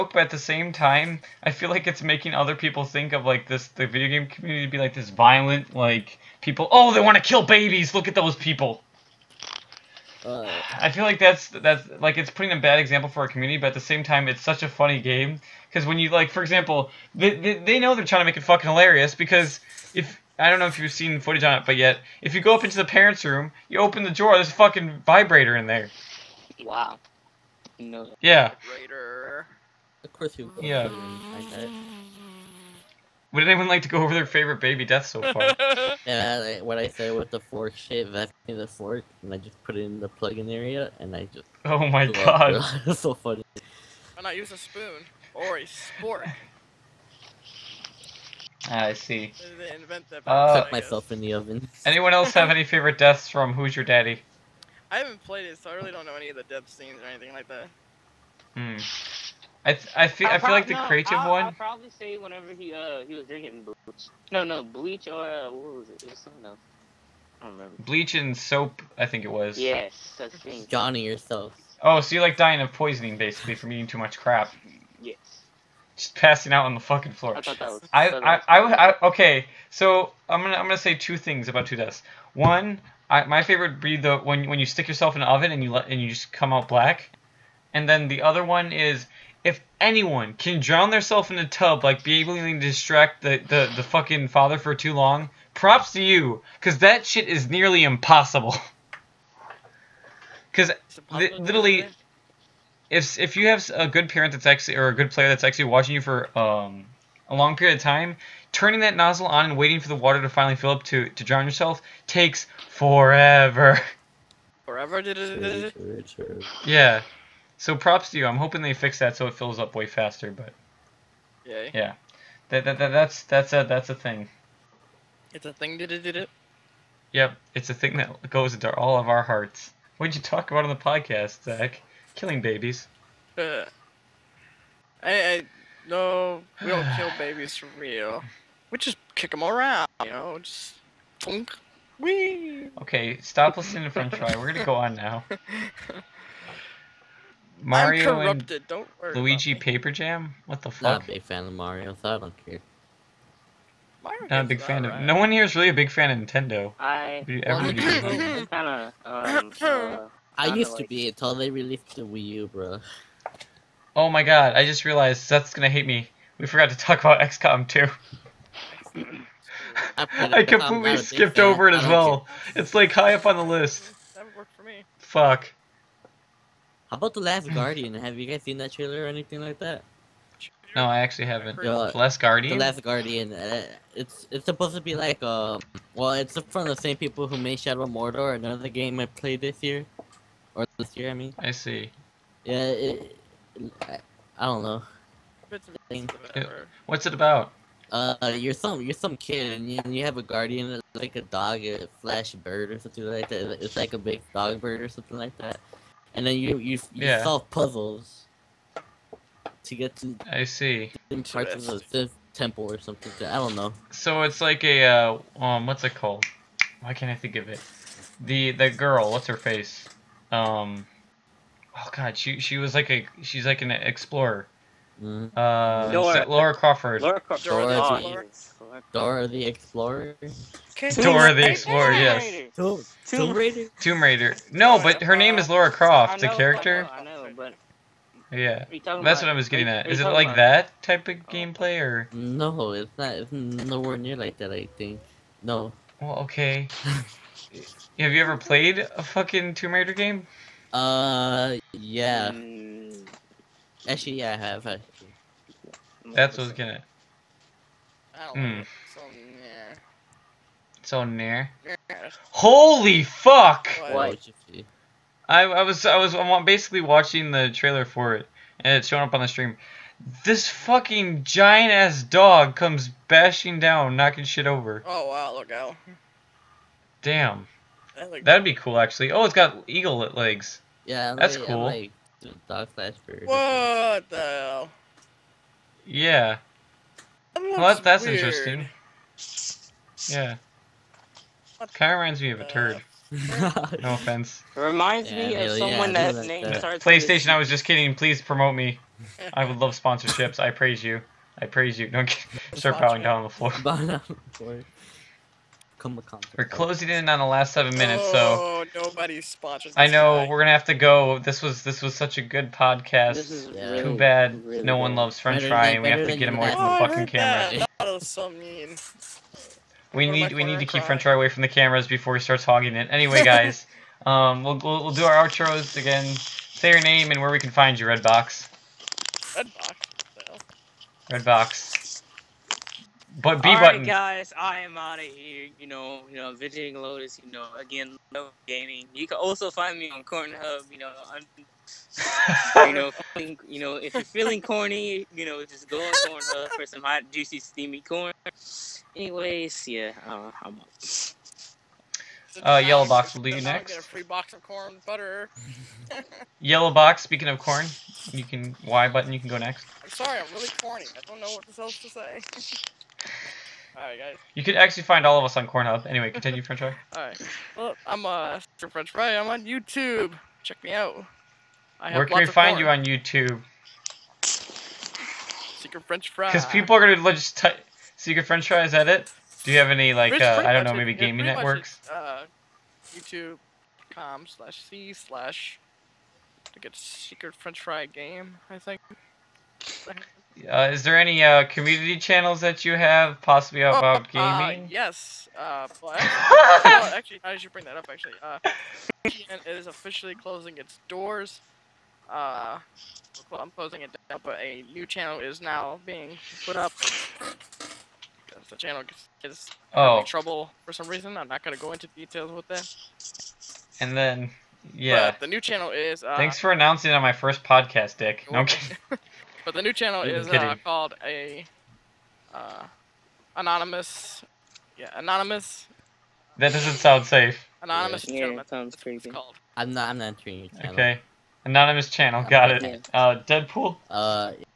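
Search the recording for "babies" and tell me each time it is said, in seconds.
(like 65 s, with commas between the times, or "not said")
7 s, 132 s, 137 s.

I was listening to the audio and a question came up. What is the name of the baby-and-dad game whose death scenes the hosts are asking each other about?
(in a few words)
Who's Your Daddy.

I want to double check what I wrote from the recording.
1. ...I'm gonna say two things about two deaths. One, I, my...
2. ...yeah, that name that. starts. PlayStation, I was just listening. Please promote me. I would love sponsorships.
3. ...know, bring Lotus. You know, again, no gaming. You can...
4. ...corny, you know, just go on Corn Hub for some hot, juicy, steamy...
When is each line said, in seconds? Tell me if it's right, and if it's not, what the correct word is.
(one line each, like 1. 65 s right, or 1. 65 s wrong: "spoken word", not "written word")
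1. 80 s right
2. 295 s wrong: "kidding", not "listening"
3. 336 s wrong: "visiting", not "bring"
4. 344 s right.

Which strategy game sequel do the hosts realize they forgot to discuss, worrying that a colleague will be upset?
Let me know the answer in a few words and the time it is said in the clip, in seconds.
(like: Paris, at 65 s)
XCOM 2, at 167 s.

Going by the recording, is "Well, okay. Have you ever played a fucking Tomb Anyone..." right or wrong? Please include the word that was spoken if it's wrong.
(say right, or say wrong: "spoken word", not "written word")
wrong: "Raider", not "Anyone".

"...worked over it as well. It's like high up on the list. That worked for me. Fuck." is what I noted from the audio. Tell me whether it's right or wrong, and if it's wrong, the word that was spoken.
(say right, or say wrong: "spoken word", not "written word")
wrong: "skipped", not "worked".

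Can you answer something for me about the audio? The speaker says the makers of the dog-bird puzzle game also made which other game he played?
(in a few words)
Shadow of Mordor.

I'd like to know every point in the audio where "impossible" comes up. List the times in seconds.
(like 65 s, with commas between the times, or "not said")
97 s.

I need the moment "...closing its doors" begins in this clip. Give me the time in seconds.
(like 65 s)
400 s.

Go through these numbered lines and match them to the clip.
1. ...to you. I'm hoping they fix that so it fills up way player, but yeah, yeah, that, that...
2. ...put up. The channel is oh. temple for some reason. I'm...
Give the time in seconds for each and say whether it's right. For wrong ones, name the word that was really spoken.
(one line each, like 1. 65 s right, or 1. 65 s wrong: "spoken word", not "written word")
1. 118 s wrong: "faster", not "player"
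2. 406 s wrong: "trouble", not "temple".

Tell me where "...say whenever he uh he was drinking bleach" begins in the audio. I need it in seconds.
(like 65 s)
61 s.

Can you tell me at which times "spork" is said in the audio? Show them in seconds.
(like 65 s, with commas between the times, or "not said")
45 s.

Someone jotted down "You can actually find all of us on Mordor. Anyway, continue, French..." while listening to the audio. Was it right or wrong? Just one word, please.
wrong.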